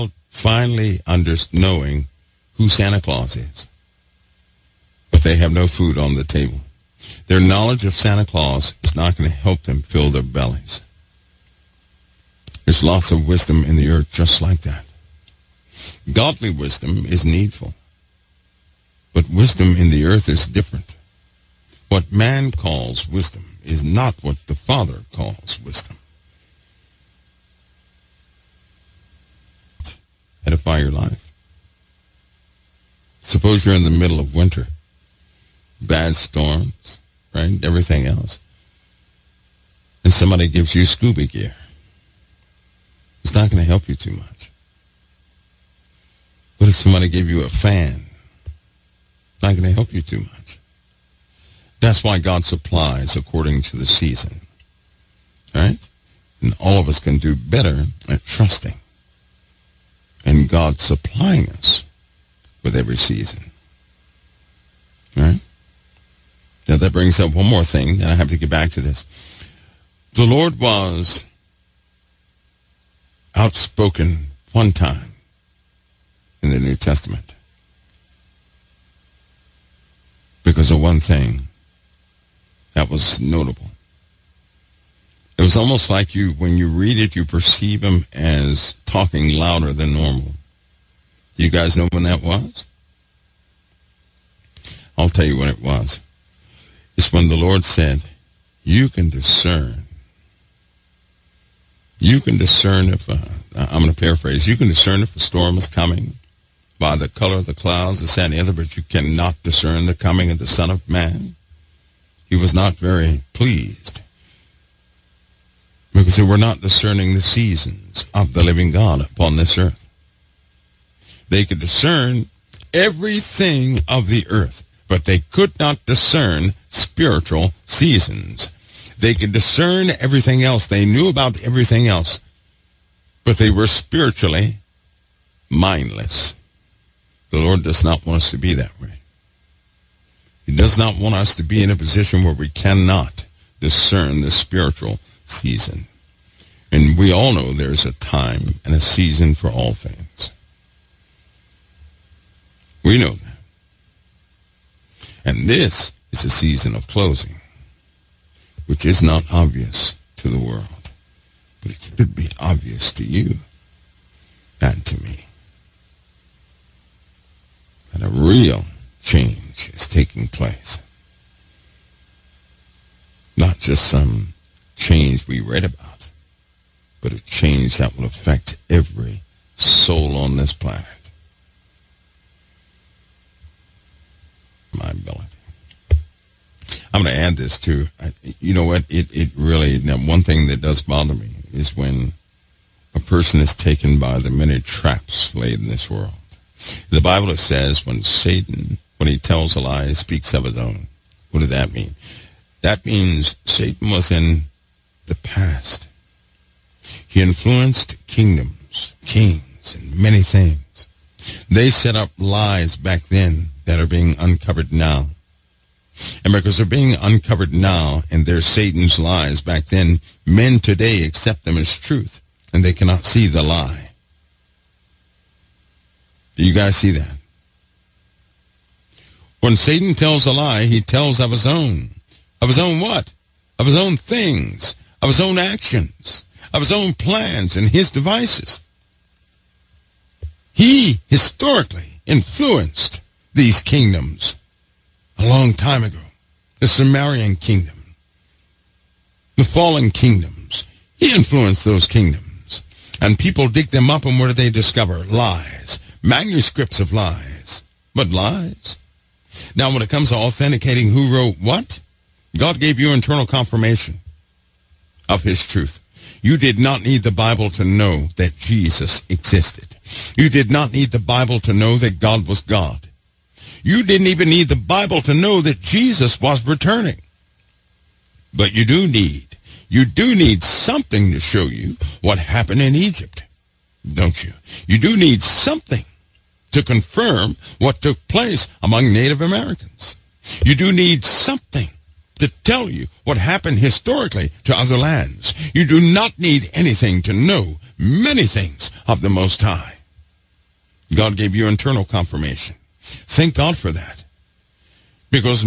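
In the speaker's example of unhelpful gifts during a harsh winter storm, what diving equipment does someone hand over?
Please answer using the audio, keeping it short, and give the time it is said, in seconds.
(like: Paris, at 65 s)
scuba gear, at 40 s.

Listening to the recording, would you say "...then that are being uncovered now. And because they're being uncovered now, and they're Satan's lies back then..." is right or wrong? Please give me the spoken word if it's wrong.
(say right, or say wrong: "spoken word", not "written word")
right.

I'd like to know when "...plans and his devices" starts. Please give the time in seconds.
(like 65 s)
236 s.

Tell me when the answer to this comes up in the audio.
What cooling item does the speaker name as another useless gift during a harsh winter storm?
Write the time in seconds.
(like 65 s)
47 s.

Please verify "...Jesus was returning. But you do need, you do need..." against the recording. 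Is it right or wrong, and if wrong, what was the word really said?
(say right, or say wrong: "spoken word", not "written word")
right.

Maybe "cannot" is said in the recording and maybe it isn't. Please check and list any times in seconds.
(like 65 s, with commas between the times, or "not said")
108 s, 142 s, 222 s.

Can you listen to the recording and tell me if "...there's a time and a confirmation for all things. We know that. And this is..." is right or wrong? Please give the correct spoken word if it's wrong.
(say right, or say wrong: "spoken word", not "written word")
wrong: "season", not "confirmation".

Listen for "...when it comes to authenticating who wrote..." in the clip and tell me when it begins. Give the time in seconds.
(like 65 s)
259 s.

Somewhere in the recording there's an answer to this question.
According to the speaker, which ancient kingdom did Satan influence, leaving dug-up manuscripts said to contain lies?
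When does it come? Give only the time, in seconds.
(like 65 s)
246 s.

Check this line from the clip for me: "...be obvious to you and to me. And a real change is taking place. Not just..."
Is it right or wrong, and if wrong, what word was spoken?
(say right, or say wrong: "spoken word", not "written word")
right.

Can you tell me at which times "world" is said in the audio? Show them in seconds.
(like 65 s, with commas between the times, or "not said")
160 s, 195 s.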